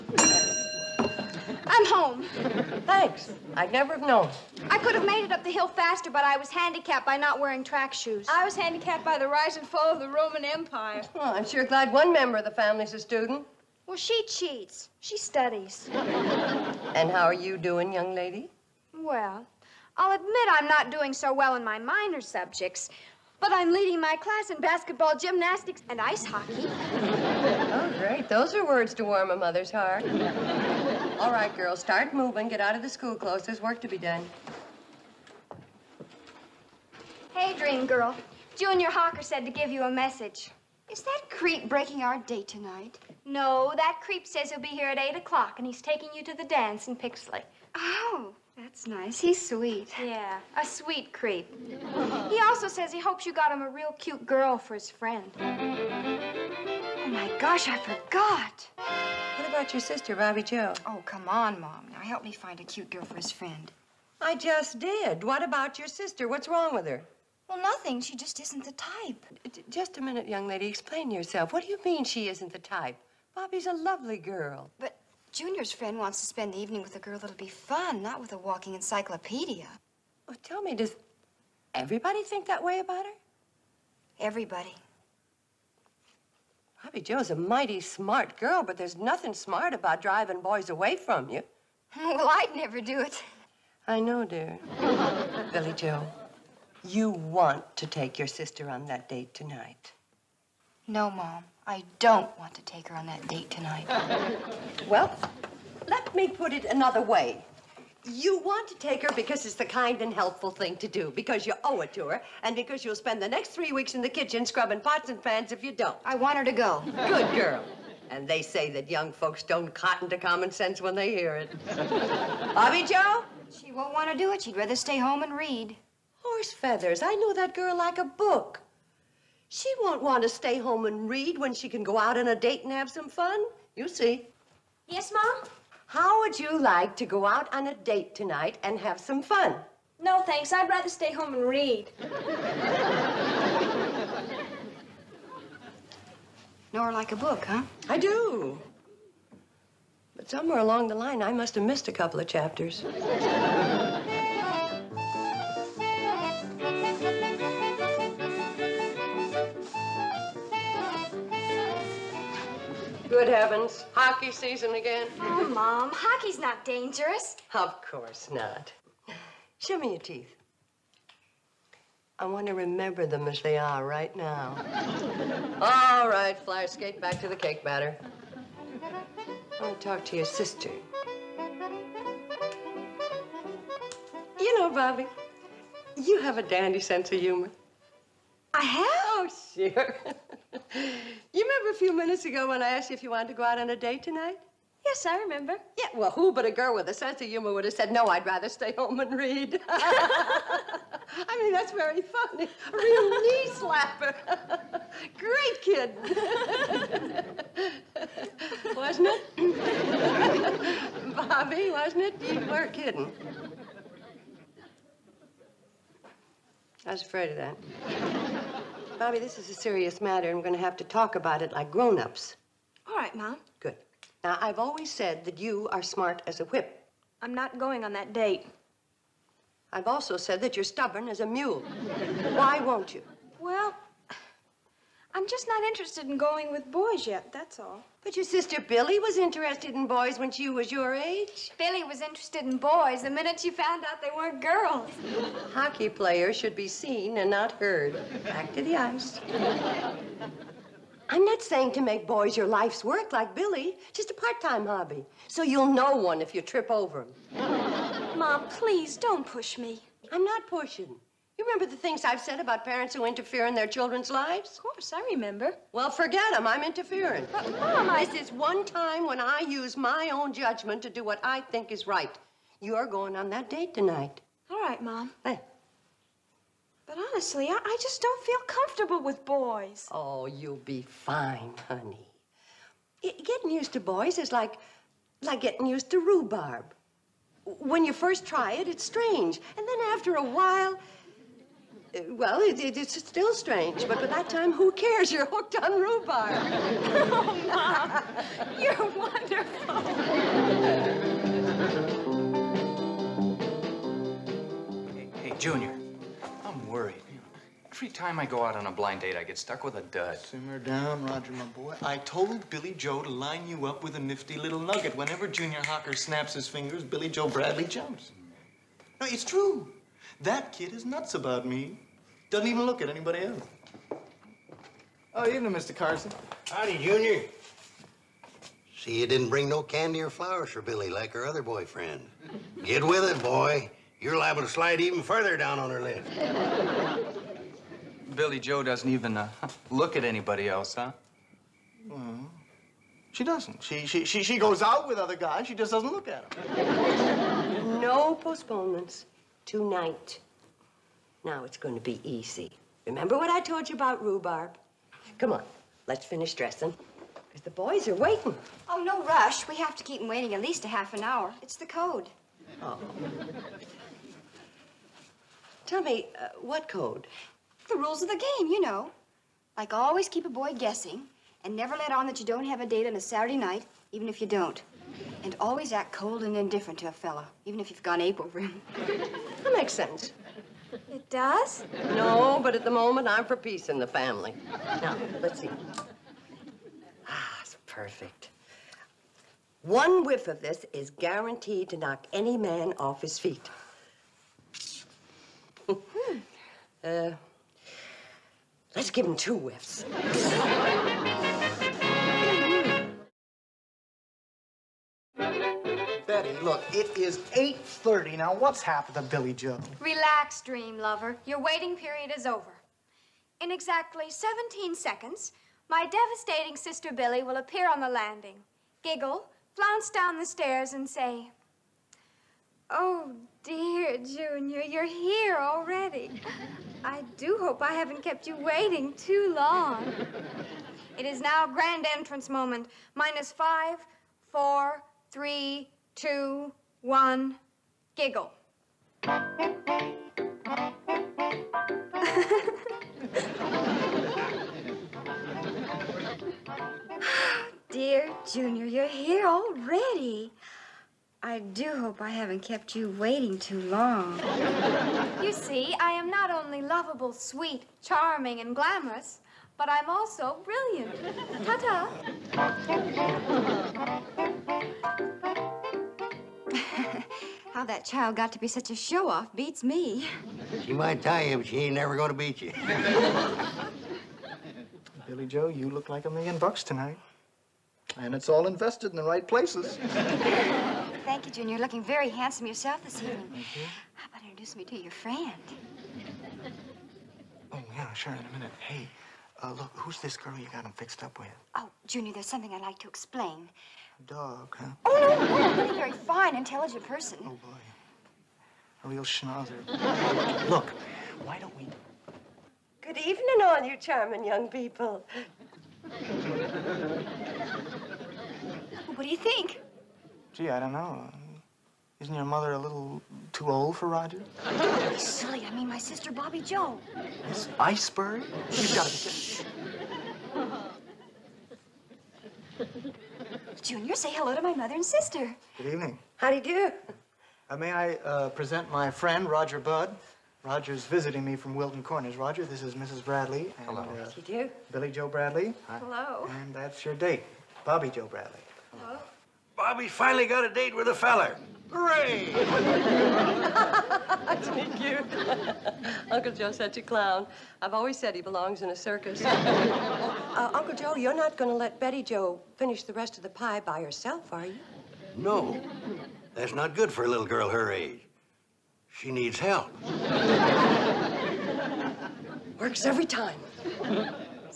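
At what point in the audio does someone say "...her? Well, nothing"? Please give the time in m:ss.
1:06.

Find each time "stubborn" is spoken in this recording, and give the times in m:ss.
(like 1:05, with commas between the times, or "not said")
3:50.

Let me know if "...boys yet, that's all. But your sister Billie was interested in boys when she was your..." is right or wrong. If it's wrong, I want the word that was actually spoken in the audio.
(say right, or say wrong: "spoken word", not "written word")
right.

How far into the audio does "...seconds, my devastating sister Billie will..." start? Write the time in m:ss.
6:54.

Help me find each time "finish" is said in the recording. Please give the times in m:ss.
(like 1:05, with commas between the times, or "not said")
5:56, 9:12.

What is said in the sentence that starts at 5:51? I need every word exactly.
Now it's going to be easy.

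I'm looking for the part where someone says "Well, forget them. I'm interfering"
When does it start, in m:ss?
4:25.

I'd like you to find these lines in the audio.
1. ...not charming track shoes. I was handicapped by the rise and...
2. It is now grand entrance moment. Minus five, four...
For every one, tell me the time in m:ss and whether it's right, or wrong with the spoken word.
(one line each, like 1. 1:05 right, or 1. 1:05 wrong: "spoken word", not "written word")
1. 0:07 wrong: "wearing", not "charming"
2. 7:10 right.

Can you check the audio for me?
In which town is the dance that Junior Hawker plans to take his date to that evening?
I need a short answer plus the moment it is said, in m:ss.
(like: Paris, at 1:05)
Pixley, at 0:46.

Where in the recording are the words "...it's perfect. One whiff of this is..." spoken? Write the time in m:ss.
6:27.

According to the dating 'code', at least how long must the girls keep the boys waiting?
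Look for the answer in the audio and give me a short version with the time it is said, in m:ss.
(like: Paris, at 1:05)
Half an hour, at 6:00.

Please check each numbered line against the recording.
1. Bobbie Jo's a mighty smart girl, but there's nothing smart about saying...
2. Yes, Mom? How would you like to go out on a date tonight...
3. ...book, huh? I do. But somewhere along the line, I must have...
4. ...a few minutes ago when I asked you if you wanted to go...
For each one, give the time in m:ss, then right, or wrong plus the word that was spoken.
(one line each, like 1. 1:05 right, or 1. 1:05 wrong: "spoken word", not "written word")
1. 1:26 wrong: "driving", not "saying"
2. 2:14 right
3. 2:27 right
4. 3:11 right.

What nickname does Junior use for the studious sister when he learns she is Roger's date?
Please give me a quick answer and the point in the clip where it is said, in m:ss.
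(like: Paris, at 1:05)
Miss Iceberg, at 8:37.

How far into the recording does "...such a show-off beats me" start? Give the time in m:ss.
7:48.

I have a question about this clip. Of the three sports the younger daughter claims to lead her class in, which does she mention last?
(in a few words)
Ice hockey.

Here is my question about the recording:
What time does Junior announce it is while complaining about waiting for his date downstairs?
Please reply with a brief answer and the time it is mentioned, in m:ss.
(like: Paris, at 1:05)
8:30, at 6:47.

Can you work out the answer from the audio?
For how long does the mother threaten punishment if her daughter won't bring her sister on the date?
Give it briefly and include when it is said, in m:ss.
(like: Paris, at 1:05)
3 weeks, at 1:53.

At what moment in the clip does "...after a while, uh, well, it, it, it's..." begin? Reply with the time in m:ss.
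4:49.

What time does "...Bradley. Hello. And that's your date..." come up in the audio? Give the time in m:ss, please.
8:55.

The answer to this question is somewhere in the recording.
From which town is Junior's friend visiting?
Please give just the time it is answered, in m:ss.
8:51.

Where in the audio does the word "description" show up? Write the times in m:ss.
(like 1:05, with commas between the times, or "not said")
not said.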